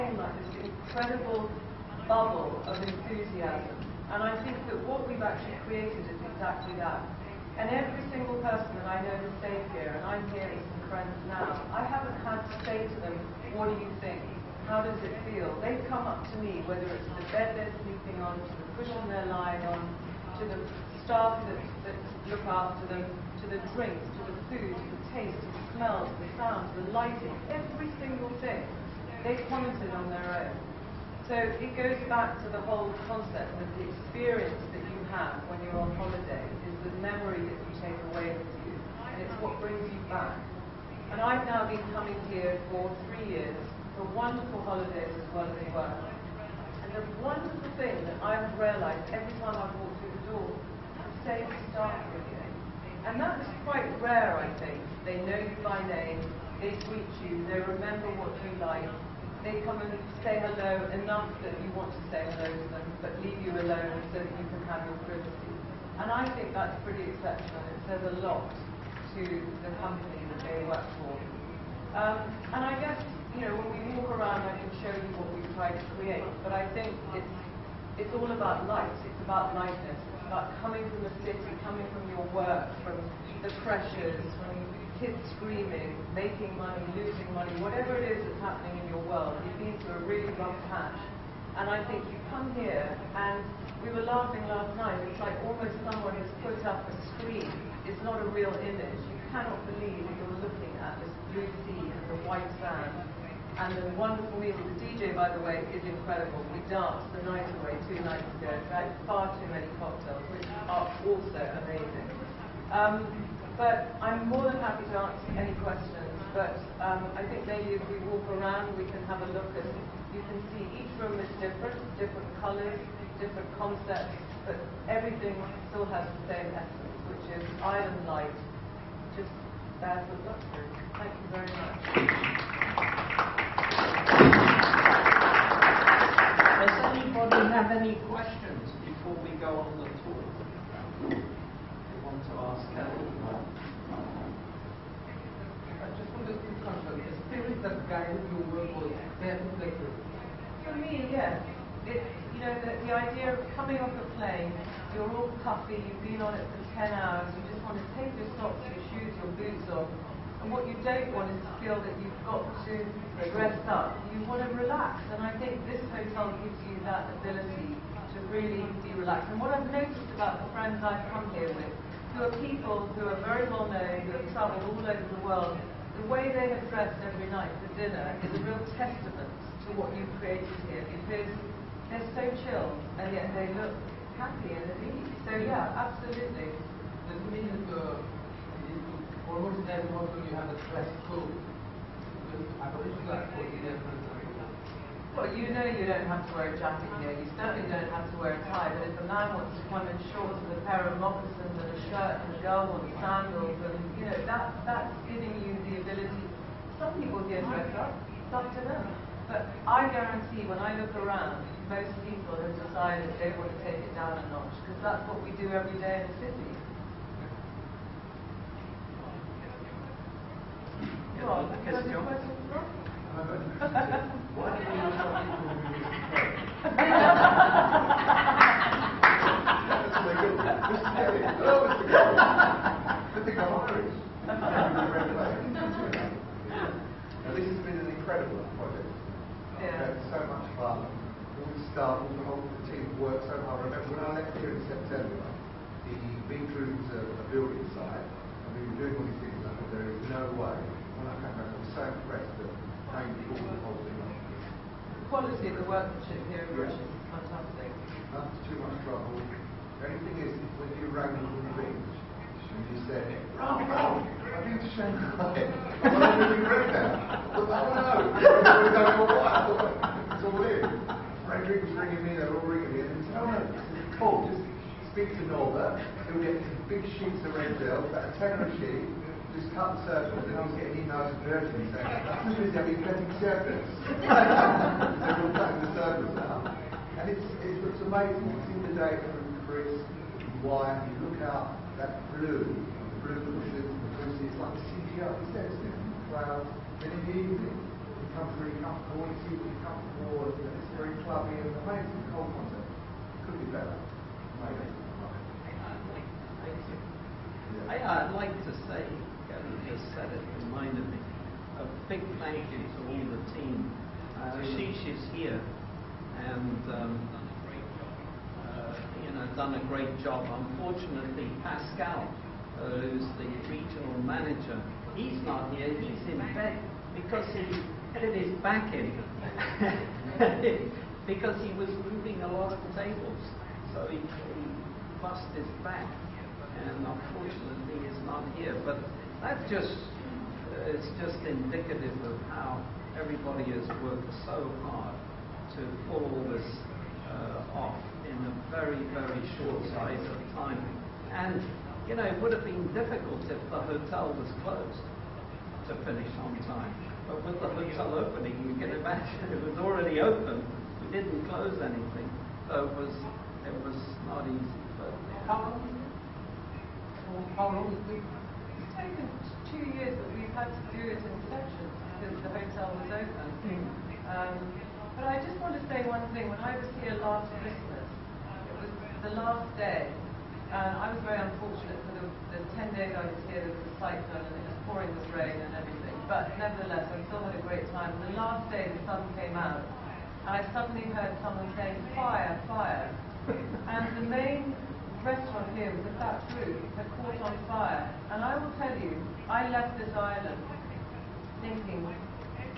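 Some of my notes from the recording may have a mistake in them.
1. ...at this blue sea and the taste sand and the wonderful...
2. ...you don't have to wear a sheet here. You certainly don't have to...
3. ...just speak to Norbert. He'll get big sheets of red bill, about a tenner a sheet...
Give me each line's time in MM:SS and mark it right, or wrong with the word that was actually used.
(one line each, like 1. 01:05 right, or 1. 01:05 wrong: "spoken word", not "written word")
1. 01:40 wrong: "white", not "taste"
2. 03:15 wrong: "jacket", not "sheet"
3. 04:34 right.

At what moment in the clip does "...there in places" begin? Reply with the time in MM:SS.
02:29.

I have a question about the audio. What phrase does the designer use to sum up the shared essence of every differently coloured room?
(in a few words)
island light.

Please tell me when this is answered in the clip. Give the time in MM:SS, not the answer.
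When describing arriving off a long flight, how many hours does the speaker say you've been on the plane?
02:36.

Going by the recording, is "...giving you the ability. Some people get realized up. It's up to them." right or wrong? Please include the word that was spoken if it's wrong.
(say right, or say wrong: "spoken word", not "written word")
wrong: "dressed", not "realized".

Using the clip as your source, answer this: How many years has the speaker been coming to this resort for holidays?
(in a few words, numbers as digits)
3 years.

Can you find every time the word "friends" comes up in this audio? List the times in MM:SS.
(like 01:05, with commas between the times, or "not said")
00:10, 02:50.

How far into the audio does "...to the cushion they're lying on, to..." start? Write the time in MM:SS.
00:18.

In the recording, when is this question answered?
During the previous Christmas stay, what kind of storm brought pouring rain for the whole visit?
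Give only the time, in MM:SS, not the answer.
06:23.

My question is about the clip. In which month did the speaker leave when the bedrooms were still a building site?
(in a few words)
September.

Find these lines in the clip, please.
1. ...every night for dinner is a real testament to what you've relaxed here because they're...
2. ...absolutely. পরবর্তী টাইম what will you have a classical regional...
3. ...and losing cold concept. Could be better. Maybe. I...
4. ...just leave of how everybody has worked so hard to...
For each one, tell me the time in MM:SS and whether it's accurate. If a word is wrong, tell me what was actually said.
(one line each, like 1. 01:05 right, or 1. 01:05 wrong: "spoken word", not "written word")
1. 02:57 wrong: "created", not "relaxed"
2. 03:05 wrong: "aboriginal", not "regional"
3. 05:01 wrong: "amazing", not "losing"
4. 05:41 wrong: "indicative", not "leave".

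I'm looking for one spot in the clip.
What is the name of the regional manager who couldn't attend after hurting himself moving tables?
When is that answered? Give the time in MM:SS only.
05:21.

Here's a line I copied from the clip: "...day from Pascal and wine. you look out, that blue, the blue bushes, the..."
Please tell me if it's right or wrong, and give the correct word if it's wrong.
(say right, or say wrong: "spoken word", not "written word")
wrong: "Chris", not "Pascal".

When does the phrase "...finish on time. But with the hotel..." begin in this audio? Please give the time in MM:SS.
05:55.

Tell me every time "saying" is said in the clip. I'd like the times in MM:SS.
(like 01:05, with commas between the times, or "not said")
04:41, 06:31.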